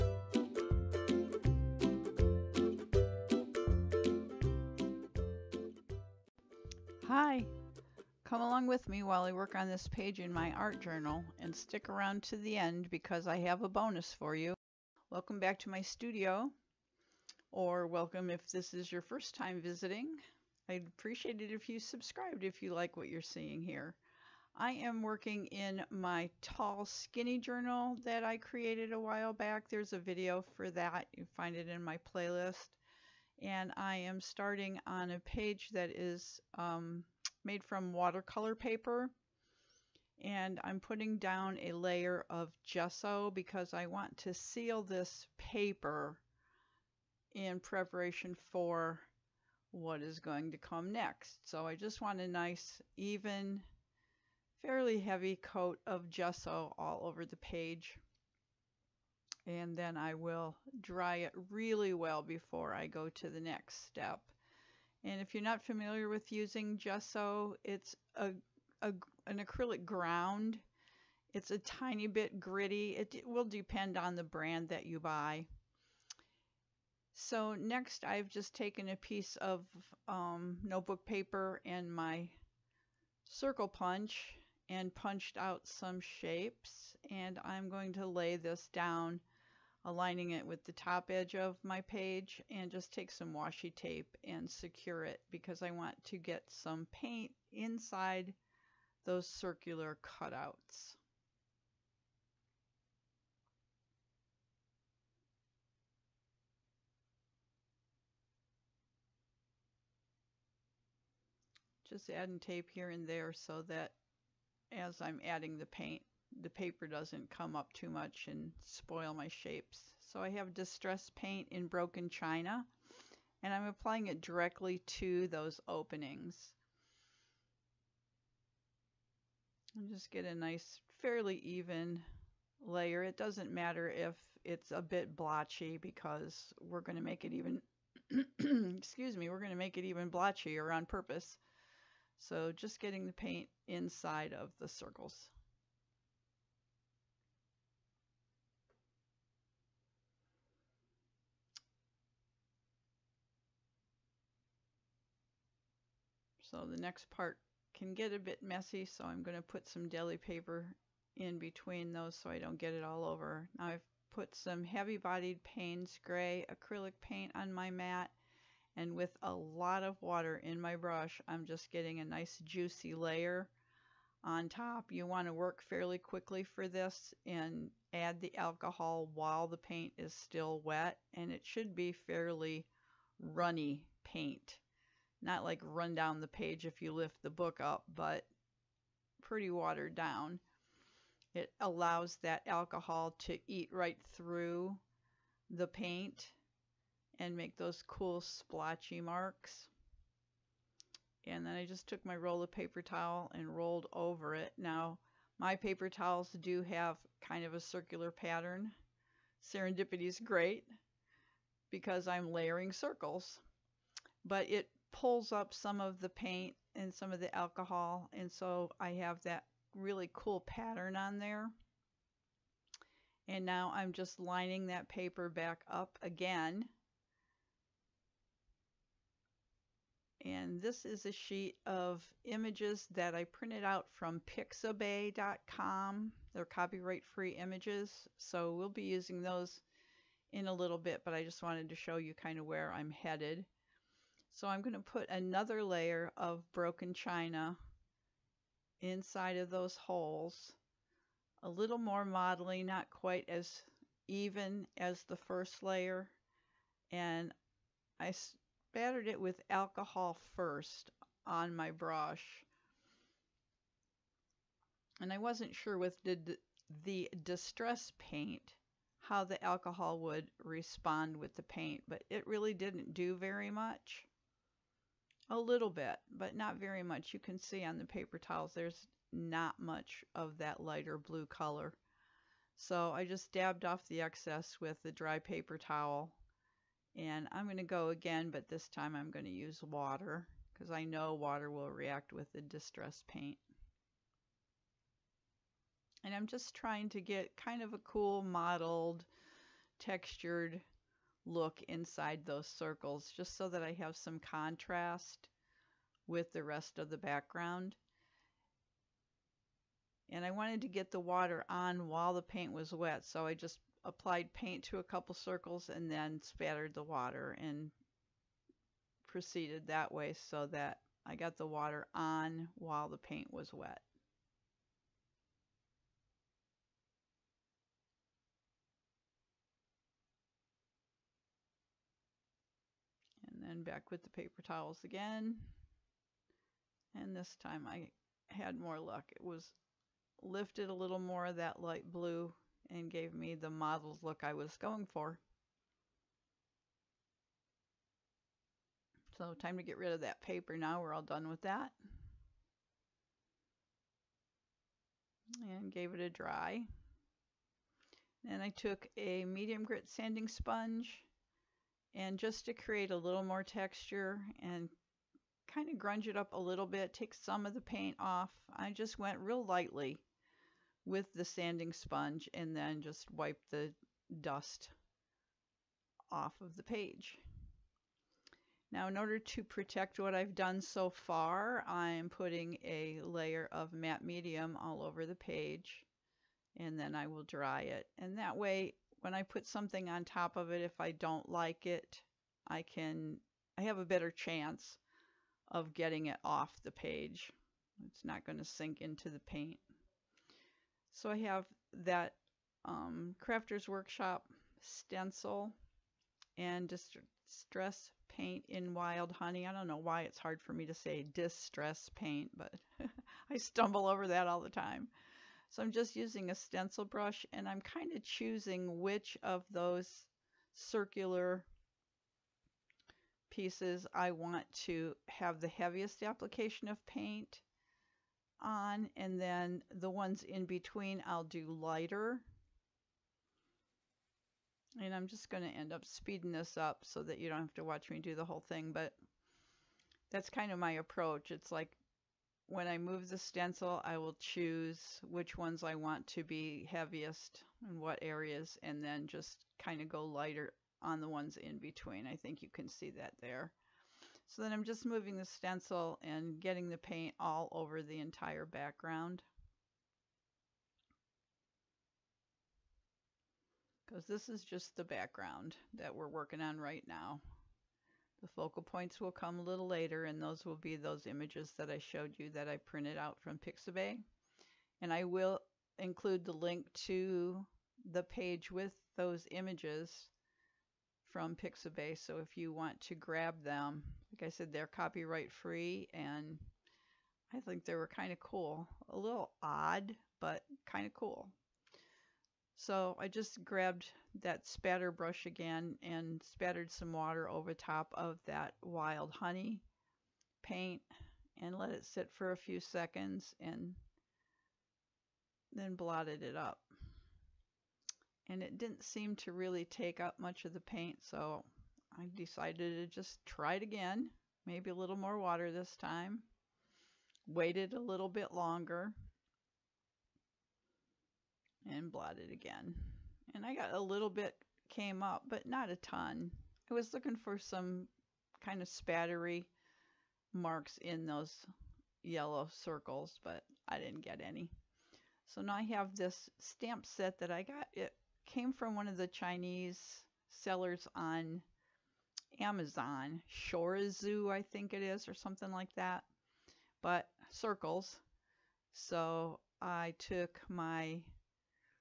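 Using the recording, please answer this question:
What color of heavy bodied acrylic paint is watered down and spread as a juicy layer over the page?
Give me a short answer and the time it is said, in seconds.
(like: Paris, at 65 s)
Payne's gray, at 165 s.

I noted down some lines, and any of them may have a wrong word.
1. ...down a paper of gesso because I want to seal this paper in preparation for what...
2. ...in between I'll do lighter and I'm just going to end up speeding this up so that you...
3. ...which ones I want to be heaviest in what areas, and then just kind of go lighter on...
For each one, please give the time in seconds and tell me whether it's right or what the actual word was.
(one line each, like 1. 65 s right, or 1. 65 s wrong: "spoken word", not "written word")
1. 41 s wrong: "layer", not "paper"
2. 430 s right
3. 445 s right.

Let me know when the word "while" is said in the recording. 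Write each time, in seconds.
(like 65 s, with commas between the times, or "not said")
9 s, 28 s, 179 s, 311 s, 322 s.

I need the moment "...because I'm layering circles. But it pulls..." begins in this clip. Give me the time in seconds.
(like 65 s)
211 s.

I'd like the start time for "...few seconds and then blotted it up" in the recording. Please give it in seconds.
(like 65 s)
502 s.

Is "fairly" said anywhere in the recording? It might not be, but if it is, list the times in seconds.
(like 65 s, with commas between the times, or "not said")
54 s, 131 s, 175 s, 181 s.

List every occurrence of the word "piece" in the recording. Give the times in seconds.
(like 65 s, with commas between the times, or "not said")
78 s, 423 s.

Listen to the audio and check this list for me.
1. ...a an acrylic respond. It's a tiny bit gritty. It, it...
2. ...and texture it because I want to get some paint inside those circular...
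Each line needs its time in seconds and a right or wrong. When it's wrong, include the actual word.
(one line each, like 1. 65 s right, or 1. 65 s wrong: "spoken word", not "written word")
1. 68 s wrong: "ground", not "respond"
2. 94 s wrong: "secure", not "texture".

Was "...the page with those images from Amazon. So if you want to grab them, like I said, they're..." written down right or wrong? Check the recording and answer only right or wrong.
wrong.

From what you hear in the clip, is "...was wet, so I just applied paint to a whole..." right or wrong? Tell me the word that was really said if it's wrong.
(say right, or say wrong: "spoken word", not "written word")
wrong: "couple", not "whole".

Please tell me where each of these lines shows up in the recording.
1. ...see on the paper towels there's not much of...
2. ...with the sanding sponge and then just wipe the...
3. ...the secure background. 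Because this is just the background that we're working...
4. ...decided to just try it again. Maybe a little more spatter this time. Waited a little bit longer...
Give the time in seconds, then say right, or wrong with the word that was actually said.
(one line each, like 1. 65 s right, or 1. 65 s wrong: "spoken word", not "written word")
1. 277 s right
2. 370 s right
3. 457 s wrong: "entire", not "secure"
4. 512 s wrong: "water", not "spatter".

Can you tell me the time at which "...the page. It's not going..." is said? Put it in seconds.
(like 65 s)
396 s.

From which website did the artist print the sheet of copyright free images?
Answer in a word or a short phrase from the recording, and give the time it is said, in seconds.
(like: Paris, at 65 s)
pixabay.com, at 234 s.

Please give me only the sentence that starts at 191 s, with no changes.
It allows that alcohol to eat right through the paint and make those cool splotchy marks.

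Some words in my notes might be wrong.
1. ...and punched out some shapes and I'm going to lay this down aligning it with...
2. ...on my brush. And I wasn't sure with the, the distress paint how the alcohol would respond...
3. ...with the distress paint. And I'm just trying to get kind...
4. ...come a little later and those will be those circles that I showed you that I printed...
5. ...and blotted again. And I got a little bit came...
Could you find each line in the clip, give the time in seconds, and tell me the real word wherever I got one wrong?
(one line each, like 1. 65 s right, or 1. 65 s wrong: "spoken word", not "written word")
1. 84 s right
2. 261 s right
3. 292 s right
4. 469 s wrong: "images", not "circles"
5. 521 s right.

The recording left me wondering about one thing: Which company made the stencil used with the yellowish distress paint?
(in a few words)
Crafter's Workshop.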